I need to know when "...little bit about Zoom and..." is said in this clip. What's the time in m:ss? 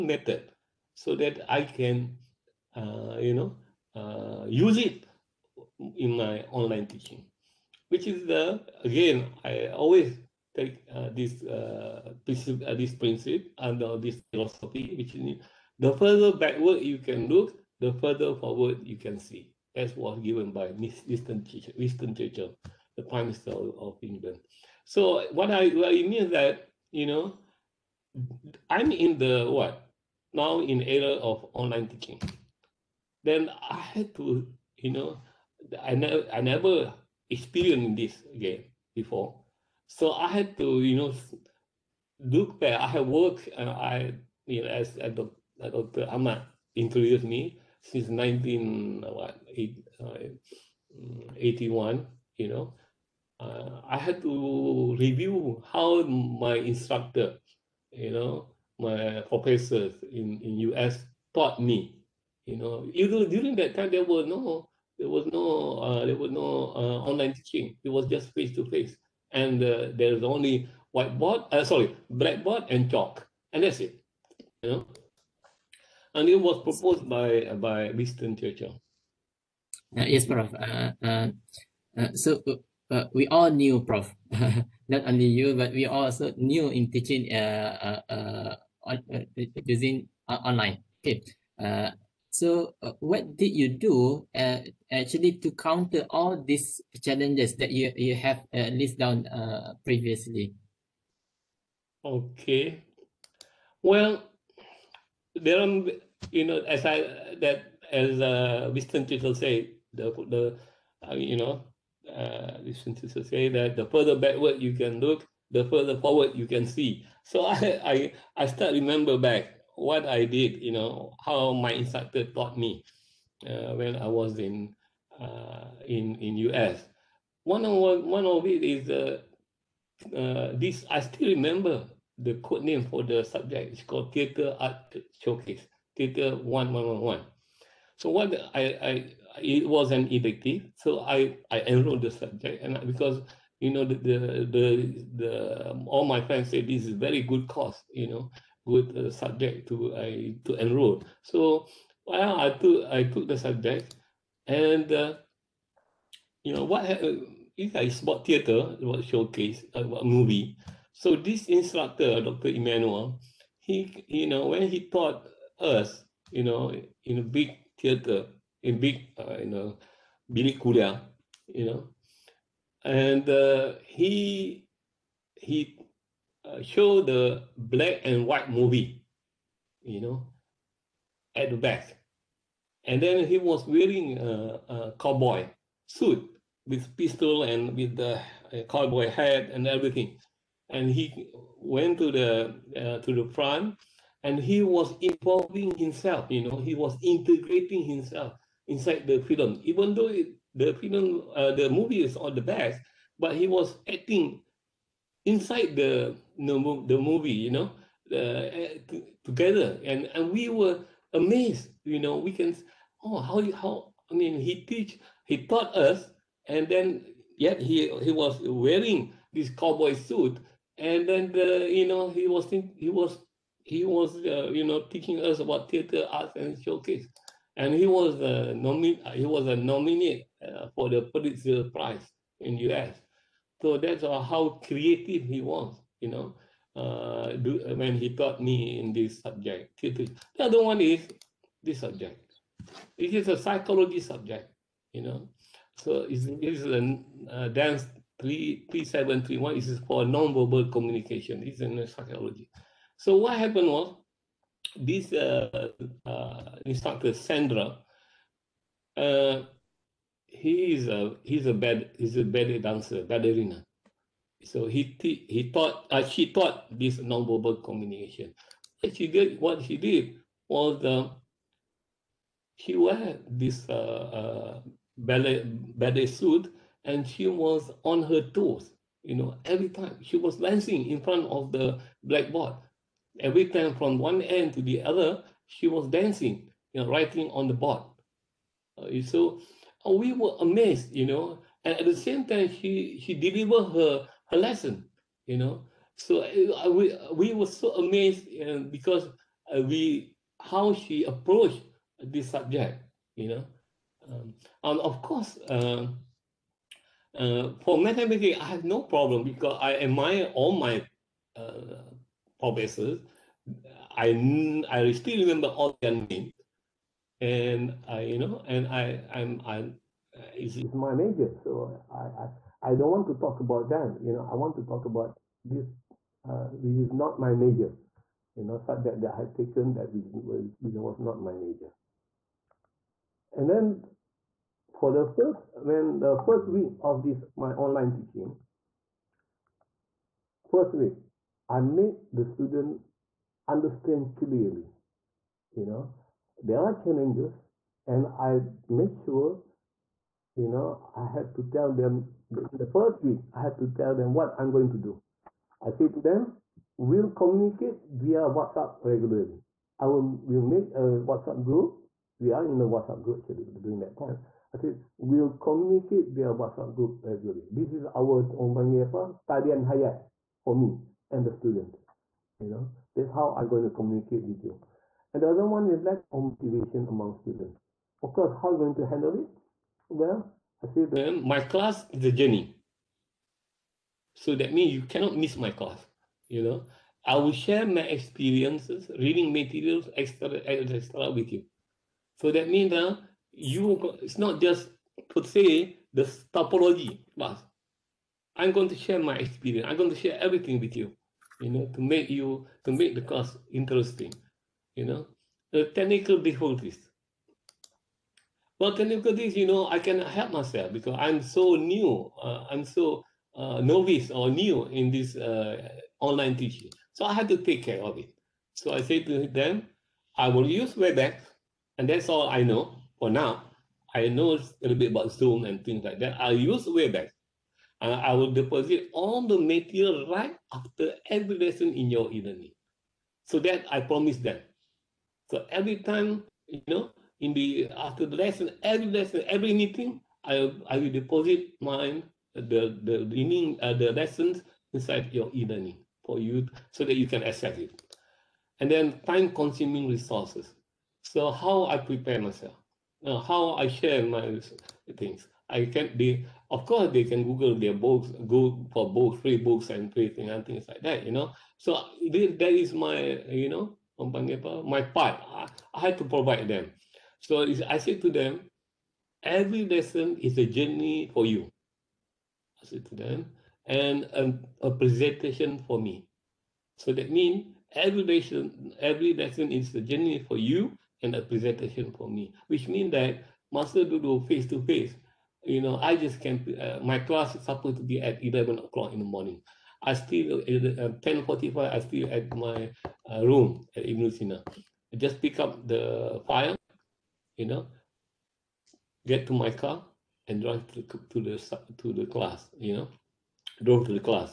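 7:04.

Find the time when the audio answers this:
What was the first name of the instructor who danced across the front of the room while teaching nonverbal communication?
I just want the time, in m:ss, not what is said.
4:17.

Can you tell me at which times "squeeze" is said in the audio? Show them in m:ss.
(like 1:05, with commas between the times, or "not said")
not said.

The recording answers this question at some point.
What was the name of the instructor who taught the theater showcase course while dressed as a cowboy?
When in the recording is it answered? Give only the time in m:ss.
2:42.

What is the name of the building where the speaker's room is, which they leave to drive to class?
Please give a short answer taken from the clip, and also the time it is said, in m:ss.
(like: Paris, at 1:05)
Ibn Sina, at 8:13.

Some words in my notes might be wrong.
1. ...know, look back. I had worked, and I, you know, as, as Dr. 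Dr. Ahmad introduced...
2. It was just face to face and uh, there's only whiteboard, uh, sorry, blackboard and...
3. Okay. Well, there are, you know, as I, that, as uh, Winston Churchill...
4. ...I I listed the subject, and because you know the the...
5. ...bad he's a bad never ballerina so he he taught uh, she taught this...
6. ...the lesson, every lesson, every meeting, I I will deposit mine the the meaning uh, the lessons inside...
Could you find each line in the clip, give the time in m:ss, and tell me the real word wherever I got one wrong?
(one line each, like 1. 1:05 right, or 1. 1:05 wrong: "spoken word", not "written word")
1. 0:40 right
2. 1:07 right
3. 1:42 right
4. 2:21 wrong: "enrolled", not "listed"
5. 4:21 wrong: "dancer", not "never"
6. 7:18 right.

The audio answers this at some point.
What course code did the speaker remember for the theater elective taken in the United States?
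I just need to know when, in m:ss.
2:15.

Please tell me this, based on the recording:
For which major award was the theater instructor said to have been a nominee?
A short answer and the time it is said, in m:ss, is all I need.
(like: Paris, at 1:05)
Pulitzer Prize, at 3:51.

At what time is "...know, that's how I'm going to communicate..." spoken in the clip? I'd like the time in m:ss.
6:12.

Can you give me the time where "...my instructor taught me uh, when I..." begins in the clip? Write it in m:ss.
2:01.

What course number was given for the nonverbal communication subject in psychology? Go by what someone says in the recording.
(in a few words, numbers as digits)
3731.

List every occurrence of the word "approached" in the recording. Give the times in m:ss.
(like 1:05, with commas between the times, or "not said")
5:01.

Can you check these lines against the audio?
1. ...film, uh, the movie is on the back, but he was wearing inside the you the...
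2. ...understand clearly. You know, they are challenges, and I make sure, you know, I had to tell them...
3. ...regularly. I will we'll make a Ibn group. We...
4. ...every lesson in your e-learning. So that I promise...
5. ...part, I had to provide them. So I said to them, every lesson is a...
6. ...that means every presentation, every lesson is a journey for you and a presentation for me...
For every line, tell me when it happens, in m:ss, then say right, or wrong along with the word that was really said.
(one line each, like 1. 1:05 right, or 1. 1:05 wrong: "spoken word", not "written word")
1. 3:20 wrong: "acting", not "wearing"
2. 5:43 right
3. 5:58 wrong: "WhatsApp", not "Ibn"
4. 7:11 right
5. 7:44 right
6. 7:56 wrong: "lesson", not "presentation".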